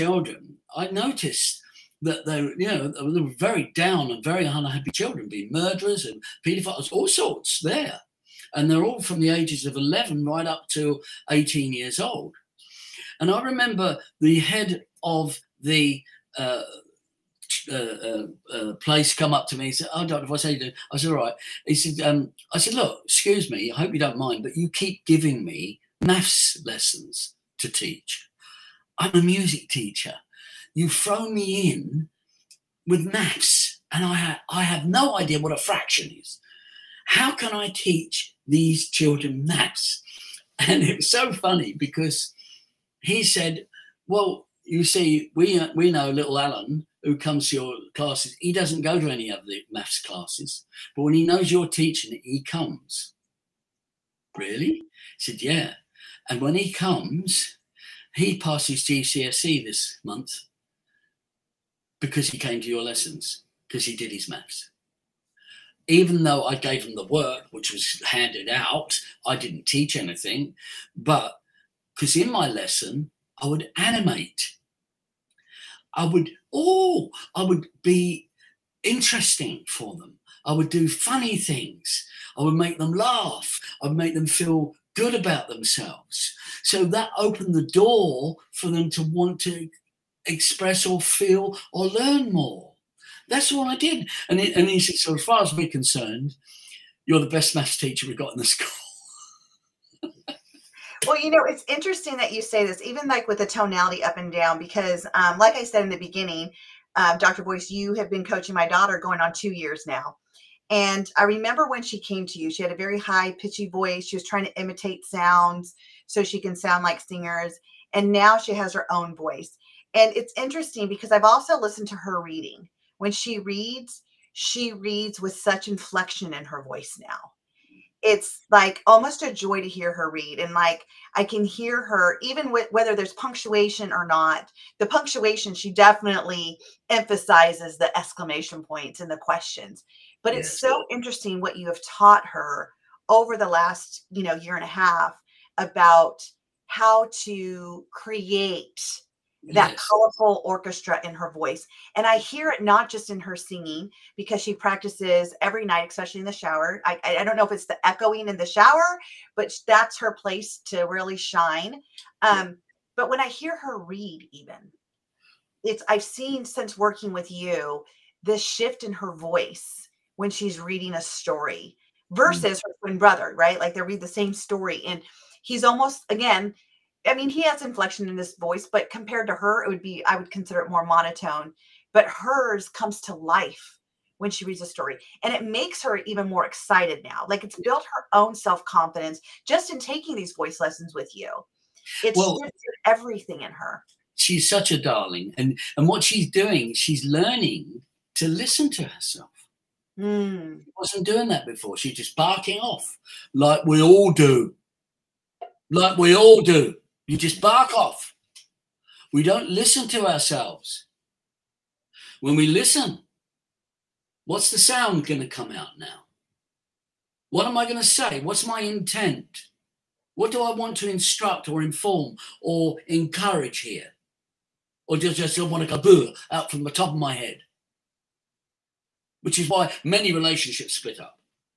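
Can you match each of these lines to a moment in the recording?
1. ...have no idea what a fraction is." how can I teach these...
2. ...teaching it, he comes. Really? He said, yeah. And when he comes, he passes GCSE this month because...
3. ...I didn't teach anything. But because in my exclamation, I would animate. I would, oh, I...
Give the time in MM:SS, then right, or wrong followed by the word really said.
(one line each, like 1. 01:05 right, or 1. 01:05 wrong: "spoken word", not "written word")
1. 00:34 right
2. 00:51 right
3. 01:09 wrong: "lesson", not "exclamation".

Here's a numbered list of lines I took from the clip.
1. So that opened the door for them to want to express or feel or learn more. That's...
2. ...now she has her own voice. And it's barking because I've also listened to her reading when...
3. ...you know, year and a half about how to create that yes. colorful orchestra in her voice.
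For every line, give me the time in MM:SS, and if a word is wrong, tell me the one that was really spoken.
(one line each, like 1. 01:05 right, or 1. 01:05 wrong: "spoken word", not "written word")
1. 01:26 right
2. 01:58 wrong: "interesting", not "barking"
3. 02:24 right.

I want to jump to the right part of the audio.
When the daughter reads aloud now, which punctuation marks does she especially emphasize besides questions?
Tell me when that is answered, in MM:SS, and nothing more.
02:17.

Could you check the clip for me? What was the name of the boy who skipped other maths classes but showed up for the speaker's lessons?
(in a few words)
Alan.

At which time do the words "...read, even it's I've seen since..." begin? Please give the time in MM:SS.
02:43.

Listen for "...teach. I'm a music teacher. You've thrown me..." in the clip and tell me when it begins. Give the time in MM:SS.
00:27.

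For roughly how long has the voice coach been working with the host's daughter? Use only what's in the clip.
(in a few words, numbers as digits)
2 years.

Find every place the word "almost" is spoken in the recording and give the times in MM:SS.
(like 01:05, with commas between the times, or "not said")
02:08, 02:55.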